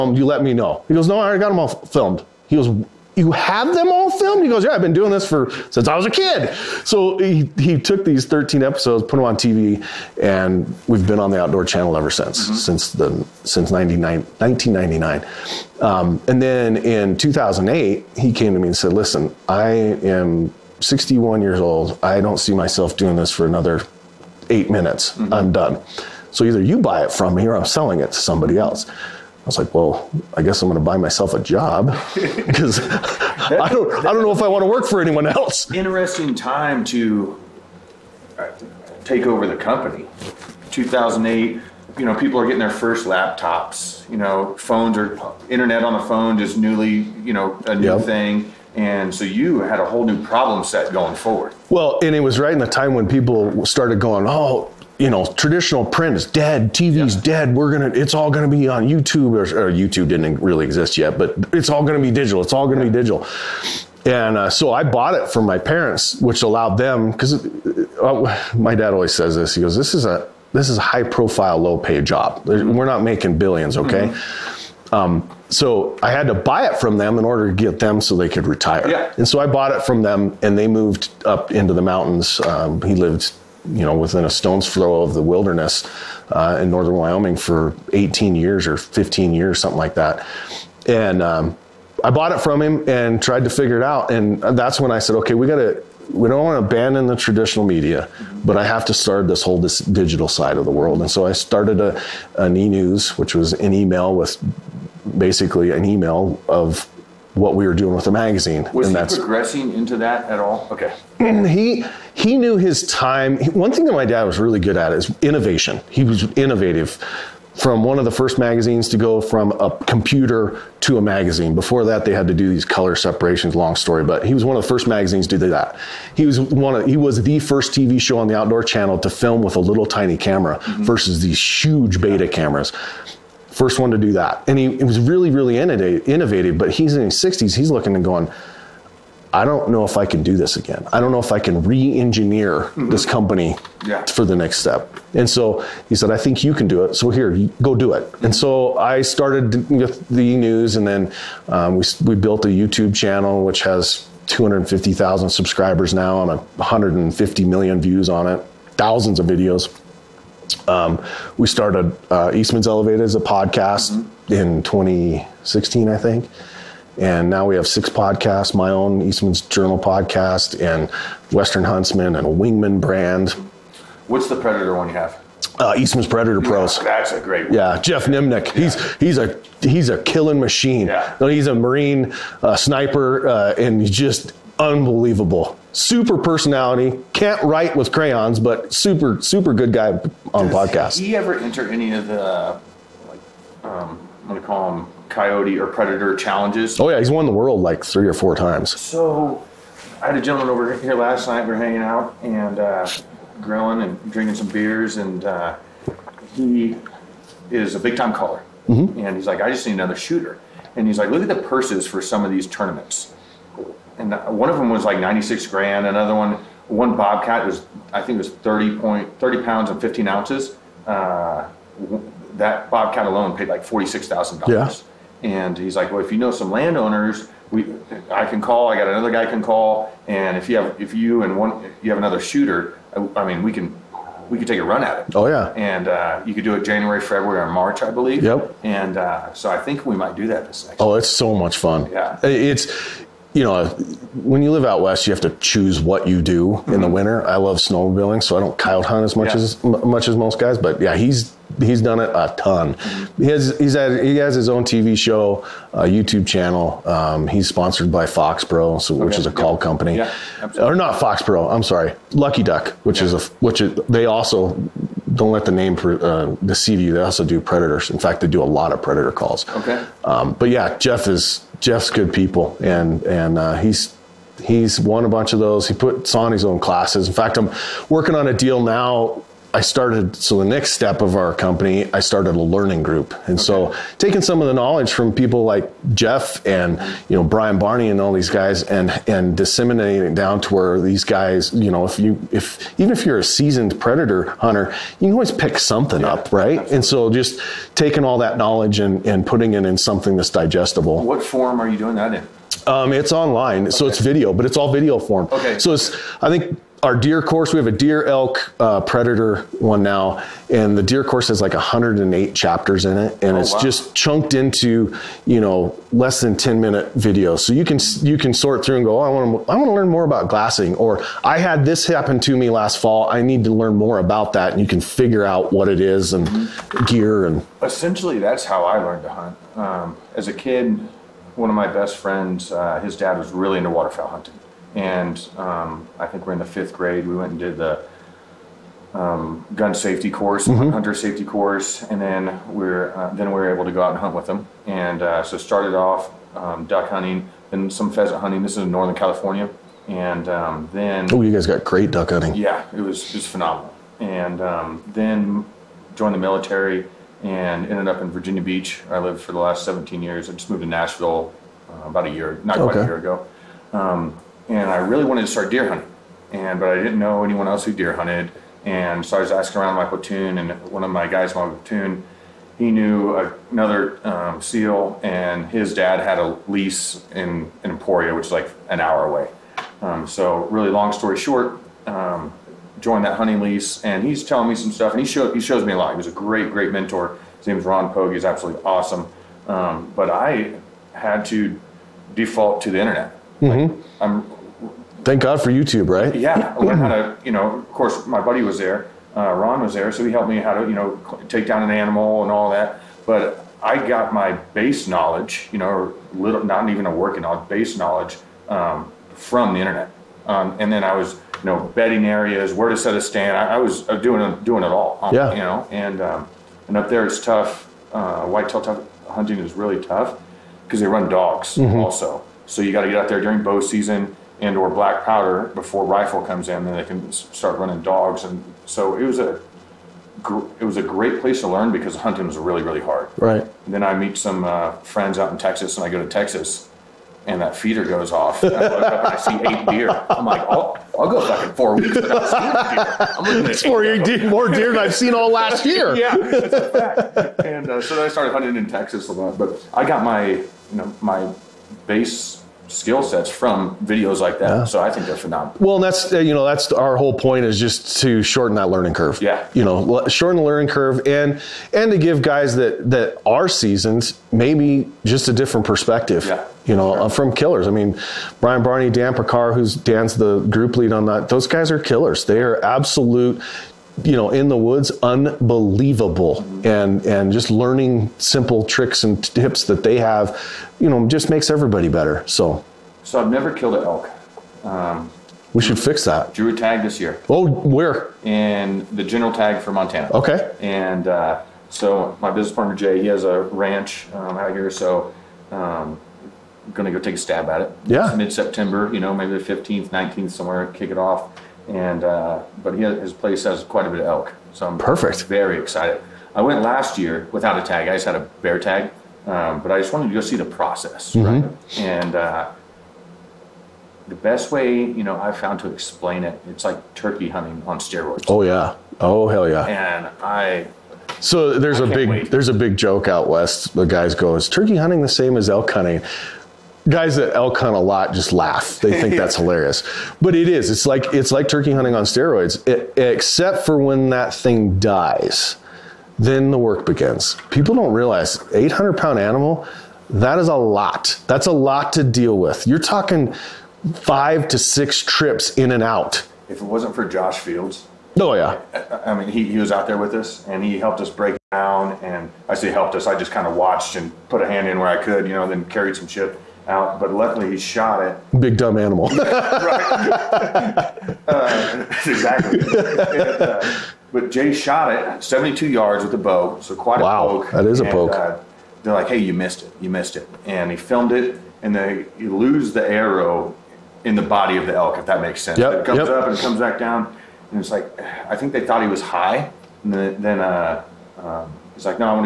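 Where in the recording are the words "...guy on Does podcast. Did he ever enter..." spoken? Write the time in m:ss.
3:09.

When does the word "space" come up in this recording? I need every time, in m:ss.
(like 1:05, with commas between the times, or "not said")
not said.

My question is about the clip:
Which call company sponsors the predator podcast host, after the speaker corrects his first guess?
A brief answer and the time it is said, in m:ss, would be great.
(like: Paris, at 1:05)
Lucky Duck, at 4:22.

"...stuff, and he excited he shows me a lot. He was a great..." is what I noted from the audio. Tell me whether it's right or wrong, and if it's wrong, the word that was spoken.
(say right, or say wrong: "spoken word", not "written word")
wrong: "showed", not "excited".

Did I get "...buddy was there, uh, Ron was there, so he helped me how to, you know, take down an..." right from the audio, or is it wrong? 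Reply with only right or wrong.
right.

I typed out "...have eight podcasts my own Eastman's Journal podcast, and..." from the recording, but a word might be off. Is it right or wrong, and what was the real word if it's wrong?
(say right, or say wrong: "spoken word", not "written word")
wrong: "six", not "eight".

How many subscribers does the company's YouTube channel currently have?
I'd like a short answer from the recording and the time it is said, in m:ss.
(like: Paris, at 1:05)
250,000, at 2:34.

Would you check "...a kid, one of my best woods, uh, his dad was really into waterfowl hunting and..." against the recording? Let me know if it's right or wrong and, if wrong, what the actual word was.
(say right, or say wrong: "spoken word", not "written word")
wrong: "friends", not "woods".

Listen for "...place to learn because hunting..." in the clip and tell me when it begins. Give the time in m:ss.
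7:11.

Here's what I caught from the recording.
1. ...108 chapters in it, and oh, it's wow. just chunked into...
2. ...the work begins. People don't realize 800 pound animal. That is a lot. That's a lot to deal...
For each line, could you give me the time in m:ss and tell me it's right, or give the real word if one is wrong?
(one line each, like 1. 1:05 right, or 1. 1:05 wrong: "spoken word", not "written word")
1. 5:11 right
2. 8:56 right.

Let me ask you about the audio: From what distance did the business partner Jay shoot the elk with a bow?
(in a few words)
72 yards.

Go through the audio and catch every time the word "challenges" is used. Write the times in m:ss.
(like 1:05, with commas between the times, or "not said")
3:16.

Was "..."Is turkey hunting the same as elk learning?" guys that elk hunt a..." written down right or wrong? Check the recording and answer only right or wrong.
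wrong.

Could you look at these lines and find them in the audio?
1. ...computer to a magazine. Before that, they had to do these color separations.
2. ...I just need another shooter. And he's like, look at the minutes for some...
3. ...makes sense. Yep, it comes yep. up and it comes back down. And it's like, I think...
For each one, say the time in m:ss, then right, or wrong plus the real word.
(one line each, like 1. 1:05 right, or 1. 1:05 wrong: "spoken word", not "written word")
1. 1:59 right
2. 3:29 wrong: "purses", not "minutes"
3. 9:35 right.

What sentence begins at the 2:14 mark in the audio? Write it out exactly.
And he, he was really, really innovative, but he's in his 60s.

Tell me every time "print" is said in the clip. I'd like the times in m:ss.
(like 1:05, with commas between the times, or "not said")
0:55.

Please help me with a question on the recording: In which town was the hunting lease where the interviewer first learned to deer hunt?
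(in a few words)
Emporia.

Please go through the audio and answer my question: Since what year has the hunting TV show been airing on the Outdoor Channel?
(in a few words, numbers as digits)
1999.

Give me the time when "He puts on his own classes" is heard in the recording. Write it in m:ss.
4:35.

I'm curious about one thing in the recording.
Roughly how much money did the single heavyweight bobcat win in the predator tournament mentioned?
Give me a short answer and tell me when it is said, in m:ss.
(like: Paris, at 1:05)
$46,000, at 3:43.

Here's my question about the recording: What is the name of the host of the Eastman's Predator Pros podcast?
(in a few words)
Jeff Nimnick.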